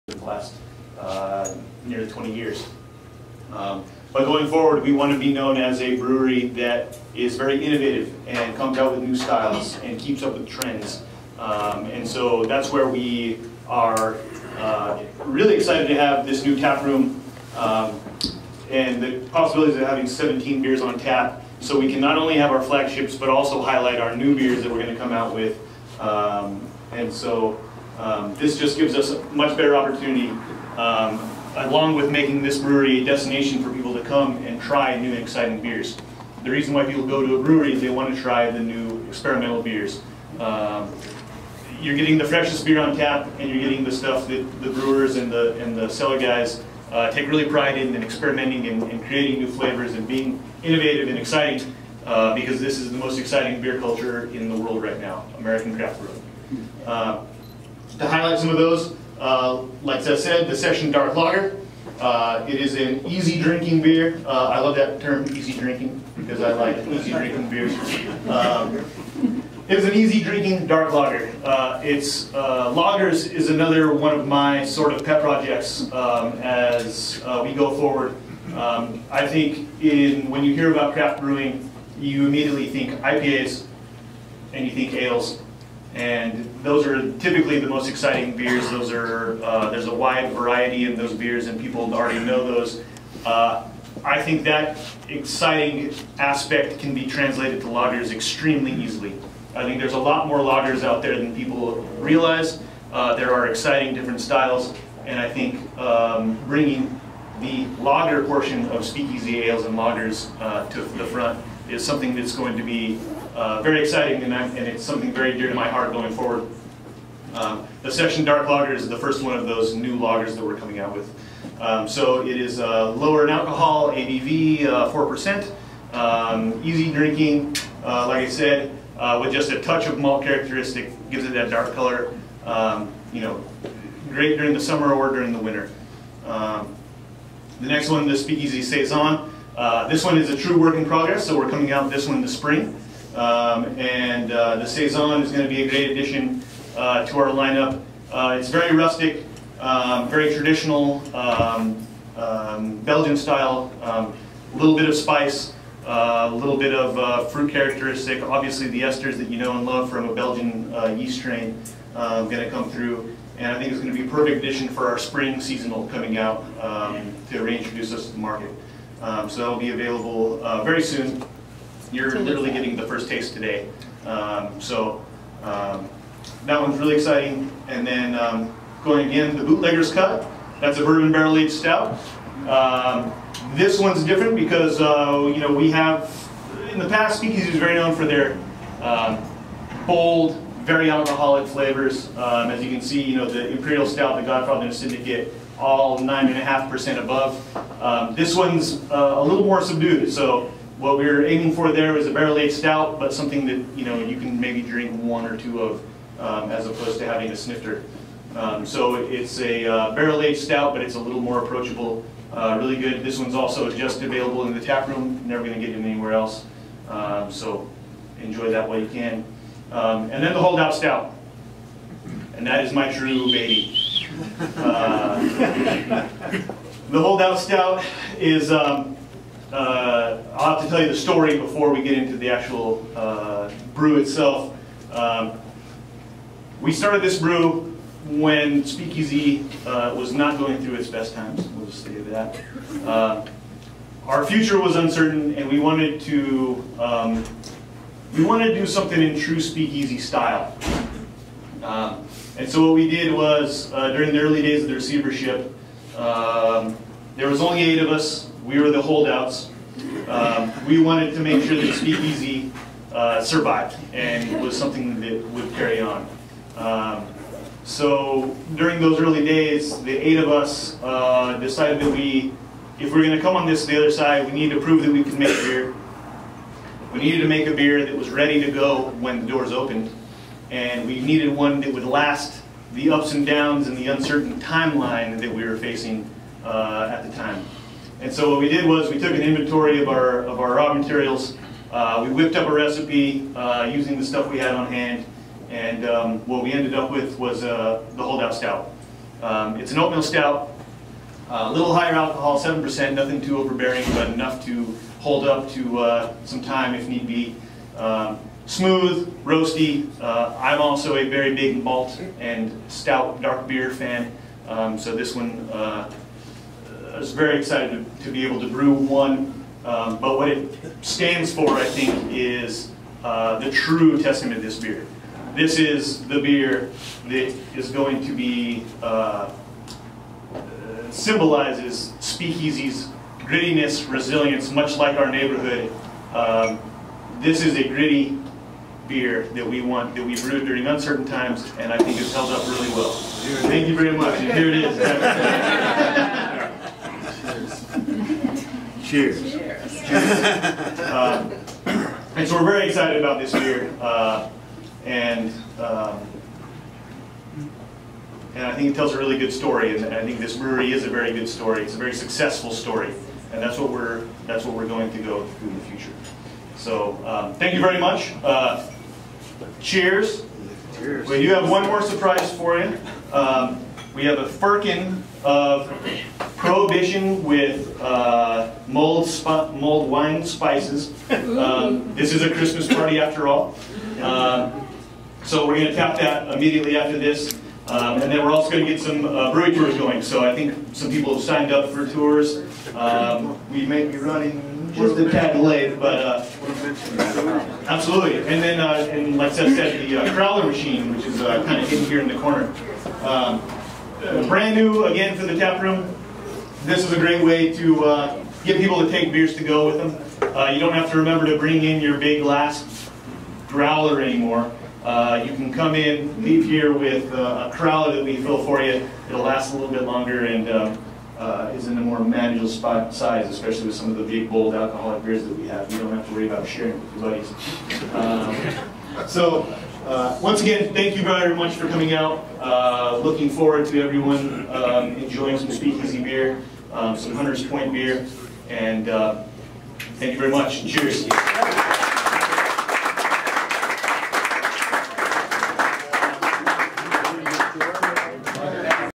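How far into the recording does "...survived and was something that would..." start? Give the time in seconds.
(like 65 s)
263 s.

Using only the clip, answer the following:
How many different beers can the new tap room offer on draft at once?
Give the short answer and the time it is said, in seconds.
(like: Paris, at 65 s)
17, at 20 s.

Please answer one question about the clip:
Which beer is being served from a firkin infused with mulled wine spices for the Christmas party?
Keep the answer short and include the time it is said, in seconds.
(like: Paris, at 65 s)
Prohibition, at 376 s.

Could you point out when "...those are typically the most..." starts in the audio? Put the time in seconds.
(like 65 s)
86 s.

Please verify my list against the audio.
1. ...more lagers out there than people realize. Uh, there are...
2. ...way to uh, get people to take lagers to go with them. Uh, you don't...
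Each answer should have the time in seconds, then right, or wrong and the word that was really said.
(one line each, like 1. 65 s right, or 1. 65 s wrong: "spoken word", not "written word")
1. 100 s right
2. 407 s wrong: "beers", not "lagers".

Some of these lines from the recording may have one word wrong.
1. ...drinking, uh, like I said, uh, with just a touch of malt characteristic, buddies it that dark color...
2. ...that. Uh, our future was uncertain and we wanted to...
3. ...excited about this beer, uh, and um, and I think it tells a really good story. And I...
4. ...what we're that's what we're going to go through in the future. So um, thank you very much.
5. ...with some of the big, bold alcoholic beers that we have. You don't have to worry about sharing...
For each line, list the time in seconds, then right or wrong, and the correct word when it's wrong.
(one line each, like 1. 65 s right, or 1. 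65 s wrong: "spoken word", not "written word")
1. 126 s wrong: "gives", not "buddies"
2. 241 s right
3. 352 s right
4. 363 s right
5. 423 s right.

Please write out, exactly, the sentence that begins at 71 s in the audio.
Uh, it's uh, lagers is another one of my sort of pet projects um, as uh, we go forward.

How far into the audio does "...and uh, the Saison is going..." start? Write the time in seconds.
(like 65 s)
143 s.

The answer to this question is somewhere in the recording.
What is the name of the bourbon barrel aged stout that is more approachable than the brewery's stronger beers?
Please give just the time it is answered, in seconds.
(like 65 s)
179 s.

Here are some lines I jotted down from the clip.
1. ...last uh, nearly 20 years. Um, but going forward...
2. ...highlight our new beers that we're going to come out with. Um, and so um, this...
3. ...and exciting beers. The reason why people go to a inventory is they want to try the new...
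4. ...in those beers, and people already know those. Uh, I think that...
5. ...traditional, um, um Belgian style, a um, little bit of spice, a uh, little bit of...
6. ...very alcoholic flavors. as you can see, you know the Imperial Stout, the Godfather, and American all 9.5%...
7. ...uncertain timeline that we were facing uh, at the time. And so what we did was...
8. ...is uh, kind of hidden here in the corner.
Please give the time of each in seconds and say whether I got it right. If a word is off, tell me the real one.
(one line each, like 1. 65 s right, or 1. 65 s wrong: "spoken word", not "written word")
1. 0 s right
2. 23 s right
3. 35 s wrong: "brewery", not "inventory"
4. 90 s right
5. 150 s right
6. 190 s wrong: "Syndicate", not "American"
7. 283 s right
8. 401 s right.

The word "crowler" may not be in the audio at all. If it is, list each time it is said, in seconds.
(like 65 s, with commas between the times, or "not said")
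400 s, 417 s.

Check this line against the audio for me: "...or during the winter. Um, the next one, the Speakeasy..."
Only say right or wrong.
right.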